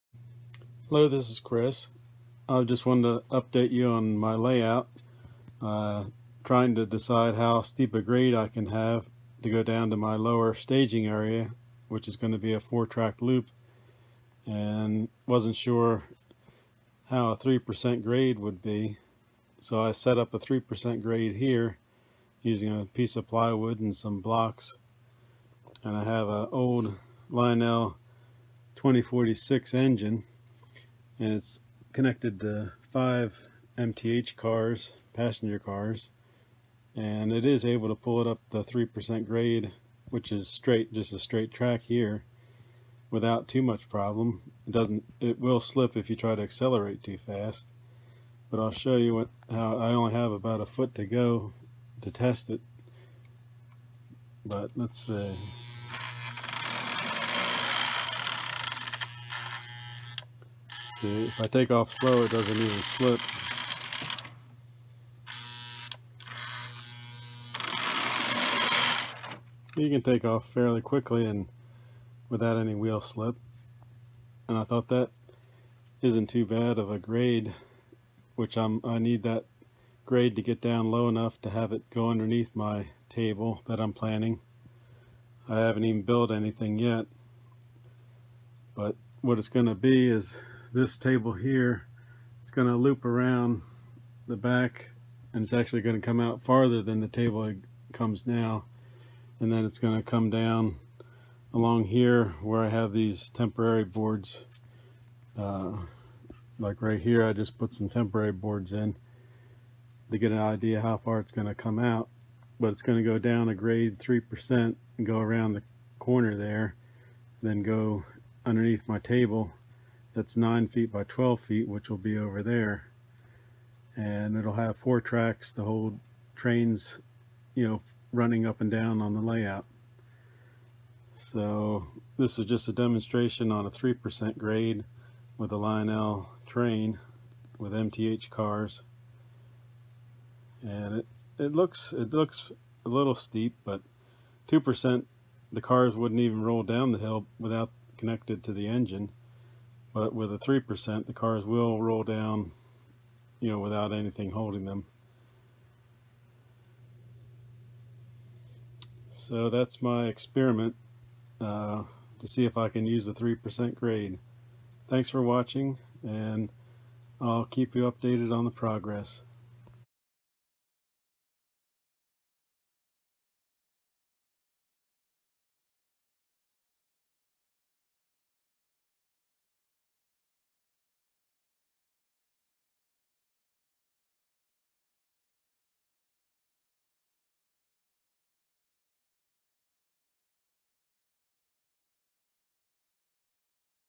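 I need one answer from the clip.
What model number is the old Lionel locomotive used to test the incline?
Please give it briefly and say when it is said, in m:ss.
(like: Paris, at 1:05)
2046, at 0:28.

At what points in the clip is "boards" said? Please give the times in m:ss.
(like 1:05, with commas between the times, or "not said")
1:43, 1:48.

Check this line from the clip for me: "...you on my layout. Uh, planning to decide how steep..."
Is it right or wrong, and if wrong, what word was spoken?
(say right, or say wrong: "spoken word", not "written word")
wrong: "trying", not "planning".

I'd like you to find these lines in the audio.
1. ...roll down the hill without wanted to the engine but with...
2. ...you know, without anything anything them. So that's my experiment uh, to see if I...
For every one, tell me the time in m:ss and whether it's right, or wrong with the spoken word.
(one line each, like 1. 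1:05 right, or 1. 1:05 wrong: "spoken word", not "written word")
1. 2:26 wrong: "connected", not "wanted"
2. 2:33 wrong: "holding", not "anything".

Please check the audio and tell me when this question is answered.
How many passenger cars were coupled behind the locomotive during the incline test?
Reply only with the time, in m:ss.
0:32.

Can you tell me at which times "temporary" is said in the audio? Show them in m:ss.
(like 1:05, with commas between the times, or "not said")
1:43, 1:47.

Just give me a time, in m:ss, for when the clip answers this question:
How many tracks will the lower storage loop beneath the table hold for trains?
2:04.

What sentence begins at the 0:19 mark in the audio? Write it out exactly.
So I set up a 3% grade here using a piece of plywood and some blocks.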